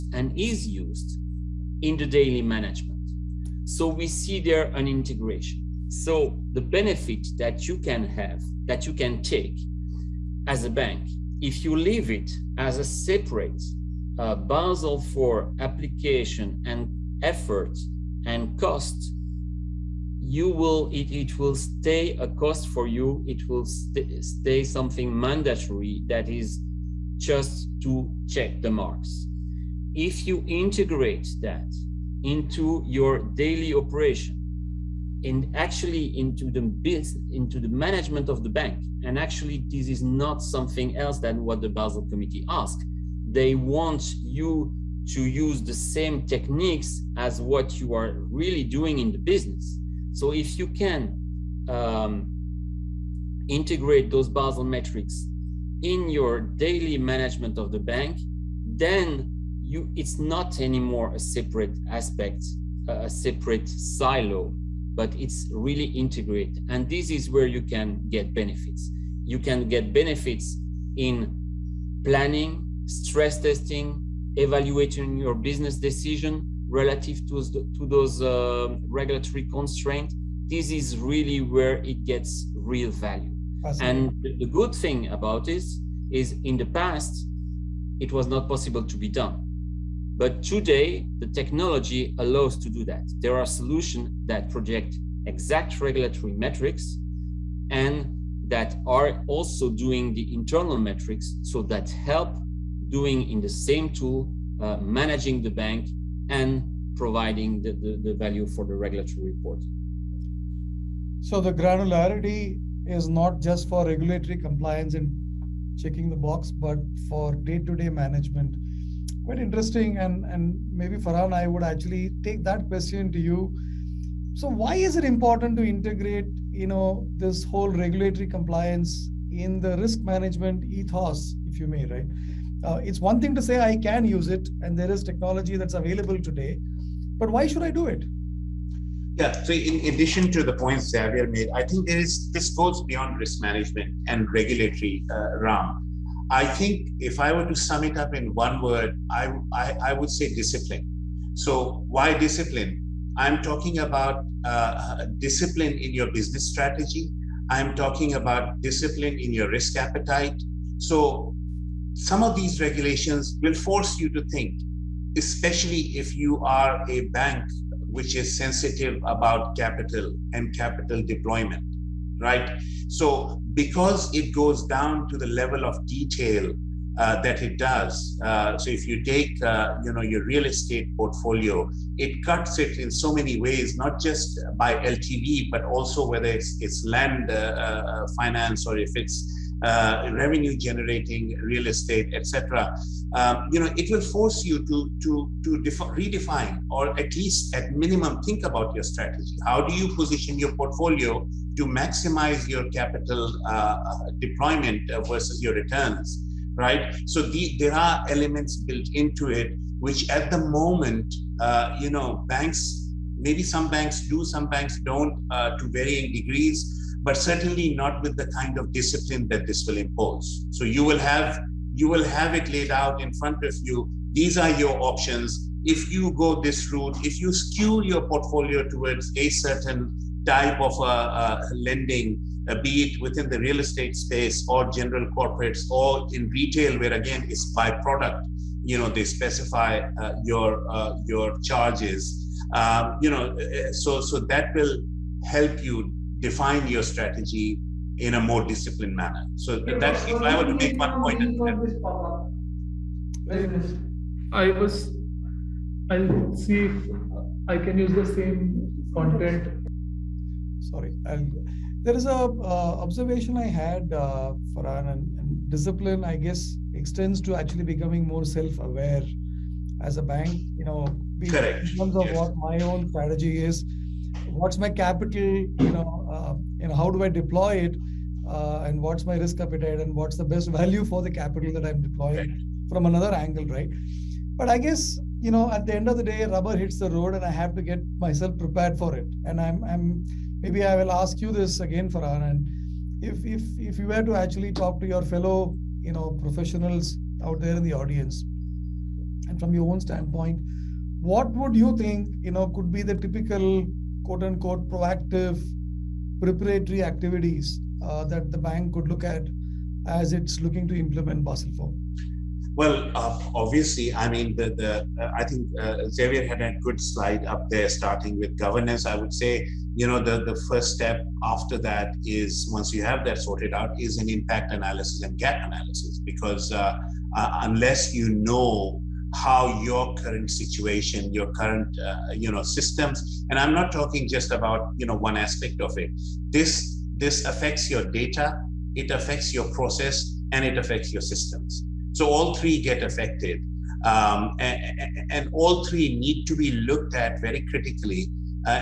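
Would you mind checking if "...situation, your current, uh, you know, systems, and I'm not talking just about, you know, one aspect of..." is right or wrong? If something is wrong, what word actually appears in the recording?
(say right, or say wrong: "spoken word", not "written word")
right.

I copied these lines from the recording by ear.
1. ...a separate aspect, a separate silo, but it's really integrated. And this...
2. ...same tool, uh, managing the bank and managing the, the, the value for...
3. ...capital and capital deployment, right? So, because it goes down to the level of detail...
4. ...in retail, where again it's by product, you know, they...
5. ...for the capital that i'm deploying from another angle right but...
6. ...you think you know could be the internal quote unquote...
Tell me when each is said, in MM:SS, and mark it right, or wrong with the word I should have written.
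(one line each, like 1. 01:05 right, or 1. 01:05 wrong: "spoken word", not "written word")
1. 01:01 right
2. 01:43 wrong: "providing", not "managing"
3. 02:49 right
4. 03:56 right
5. 04:40 right
6. 05:01 wrong: "typical", not "internal".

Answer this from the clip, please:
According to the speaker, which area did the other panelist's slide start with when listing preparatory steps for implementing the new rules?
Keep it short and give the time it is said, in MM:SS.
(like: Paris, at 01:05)
governance, at 05:18.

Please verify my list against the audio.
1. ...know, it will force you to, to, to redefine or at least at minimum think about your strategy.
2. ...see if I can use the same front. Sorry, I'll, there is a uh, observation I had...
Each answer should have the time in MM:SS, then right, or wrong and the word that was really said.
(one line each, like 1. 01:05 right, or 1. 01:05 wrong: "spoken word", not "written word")
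1. 03:13 right
2. 04:16 wrong: "content", not "front".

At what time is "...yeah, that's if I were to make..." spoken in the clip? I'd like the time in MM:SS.
04:09.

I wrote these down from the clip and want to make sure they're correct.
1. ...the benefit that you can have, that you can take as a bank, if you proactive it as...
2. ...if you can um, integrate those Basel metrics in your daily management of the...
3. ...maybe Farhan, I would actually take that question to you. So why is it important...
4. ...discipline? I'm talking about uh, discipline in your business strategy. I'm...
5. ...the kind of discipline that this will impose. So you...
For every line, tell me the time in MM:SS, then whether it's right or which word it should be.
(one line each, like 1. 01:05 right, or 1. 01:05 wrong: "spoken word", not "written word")
1. 00:06 wrong: "leave", not "proactive"
2. 00:50 right
3. 02:00 right
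4. 02:32 right
5. 03:38 right.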